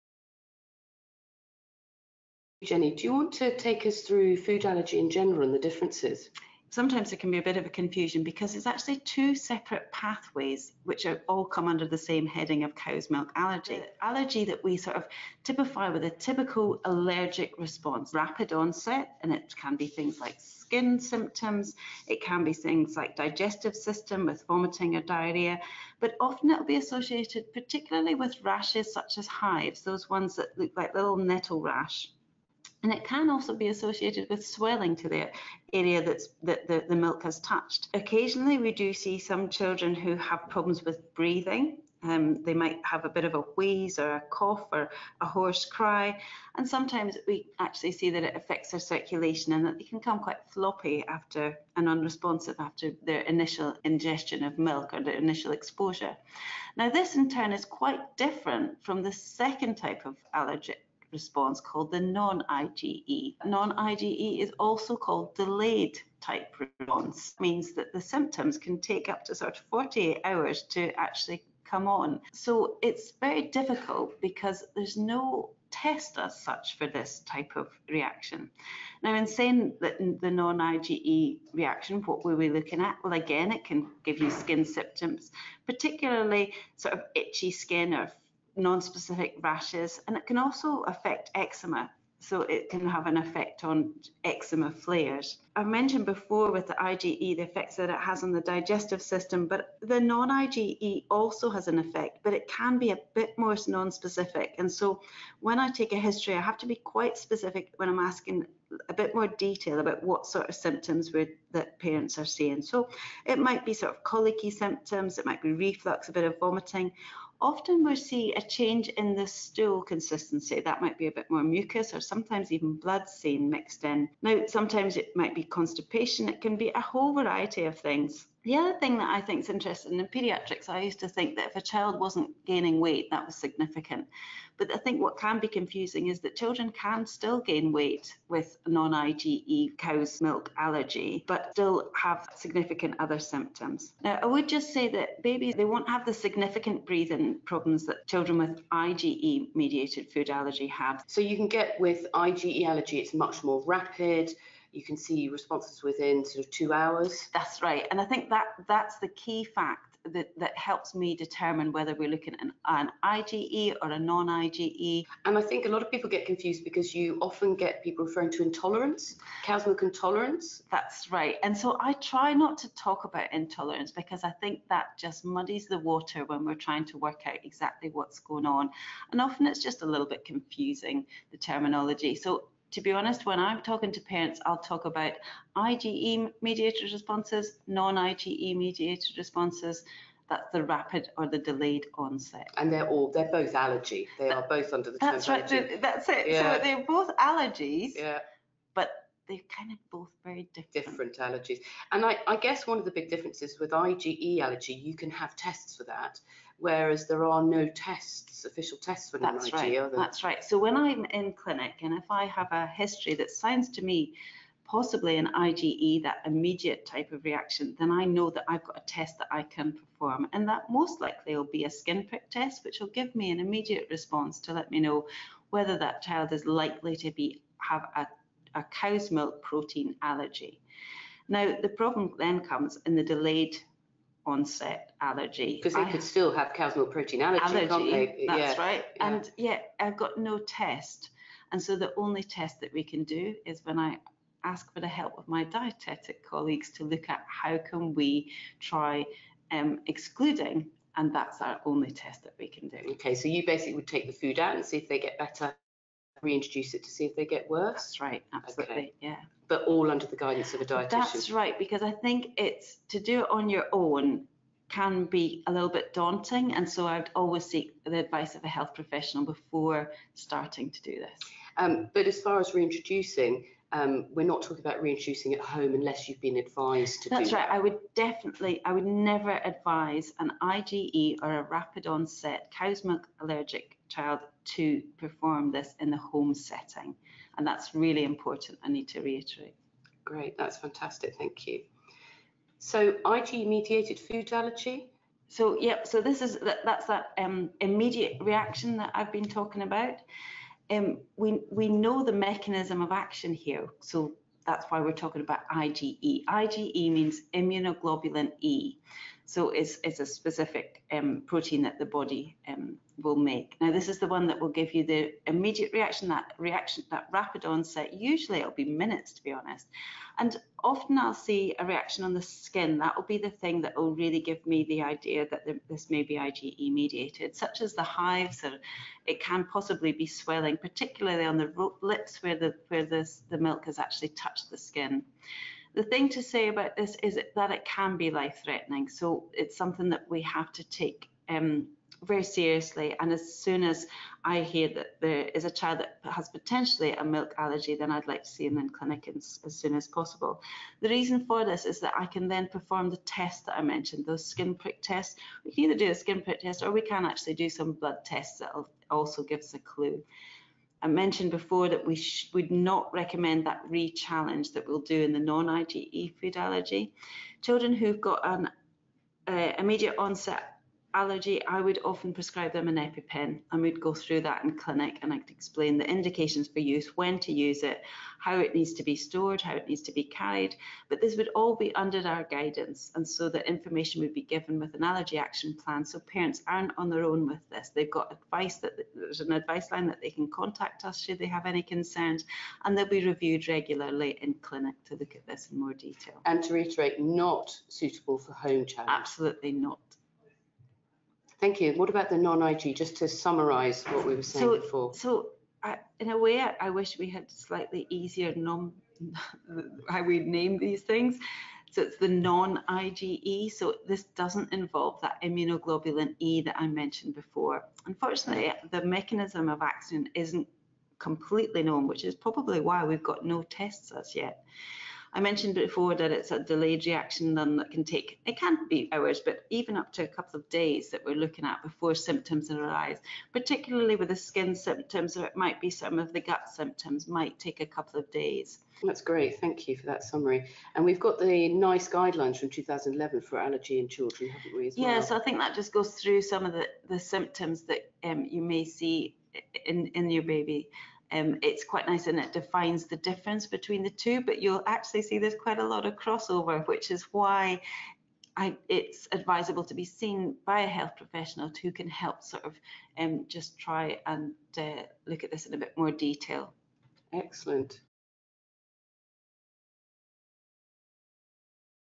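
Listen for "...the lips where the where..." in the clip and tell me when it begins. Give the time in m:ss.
5:31.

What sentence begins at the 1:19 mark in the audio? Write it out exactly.
Now, in saying that the non-IgE reaction, what were we looking at?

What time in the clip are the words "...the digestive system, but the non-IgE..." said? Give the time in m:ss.
1:38.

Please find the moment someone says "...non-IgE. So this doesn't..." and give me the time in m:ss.
6:52.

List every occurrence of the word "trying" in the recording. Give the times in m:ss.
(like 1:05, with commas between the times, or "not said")
2:56.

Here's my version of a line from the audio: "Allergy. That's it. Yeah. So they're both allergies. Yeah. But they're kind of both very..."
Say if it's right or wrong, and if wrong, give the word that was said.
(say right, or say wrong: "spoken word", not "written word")
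right.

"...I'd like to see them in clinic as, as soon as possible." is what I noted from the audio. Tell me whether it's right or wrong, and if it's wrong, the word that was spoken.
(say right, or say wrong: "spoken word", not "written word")
right.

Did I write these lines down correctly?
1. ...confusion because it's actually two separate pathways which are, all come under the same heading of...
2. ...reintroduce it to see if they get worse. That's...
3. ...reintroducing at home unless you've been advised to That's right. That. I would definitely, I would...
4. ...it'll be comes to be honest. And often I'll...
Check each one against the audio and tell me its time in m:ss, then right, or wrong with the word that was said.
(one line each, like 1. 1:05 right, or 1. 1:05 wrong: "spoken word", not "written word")
1. 0:07 right
2. 4:16 right
3. 4:34 right
4. 5:18 wrong: "minutes", not "comes".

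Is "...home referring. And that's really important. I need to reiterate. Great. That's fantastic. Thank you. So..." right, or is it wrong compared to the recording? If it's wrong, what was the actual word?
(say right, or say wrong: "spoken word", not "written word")
wrong: "setting", not "referring".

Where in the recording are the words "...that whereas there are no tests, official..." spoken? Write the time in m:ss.
3:25.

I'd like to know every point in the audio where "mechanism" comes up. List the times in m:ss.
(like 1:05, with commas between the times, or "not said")
5:02, 6:58.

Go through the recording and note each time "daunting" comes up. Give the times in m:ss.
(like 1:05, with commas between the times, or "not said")
4:25.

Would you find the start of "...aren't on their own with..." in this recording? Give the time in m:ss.
6:26.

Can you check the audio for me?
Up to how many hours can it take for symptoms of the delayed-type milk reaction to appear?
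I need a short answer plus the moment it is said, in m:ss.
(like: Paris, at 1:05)
48, at 1:09.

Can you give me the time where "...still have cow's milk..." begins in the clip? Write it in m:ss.
3:56.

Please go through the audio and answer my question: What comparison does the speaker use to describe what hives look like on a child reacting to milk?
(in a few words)
Little nettle rash.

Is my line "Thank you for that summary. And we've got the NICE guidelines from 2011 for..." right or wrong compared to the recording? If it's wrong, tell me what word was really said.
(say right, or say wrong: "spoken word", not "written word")
right.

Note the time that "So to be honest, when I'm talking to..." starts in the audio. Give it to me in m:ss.
3:02.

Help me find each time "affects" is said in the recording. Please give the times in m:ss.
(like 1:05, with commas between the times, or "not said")
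0:48, 1:30.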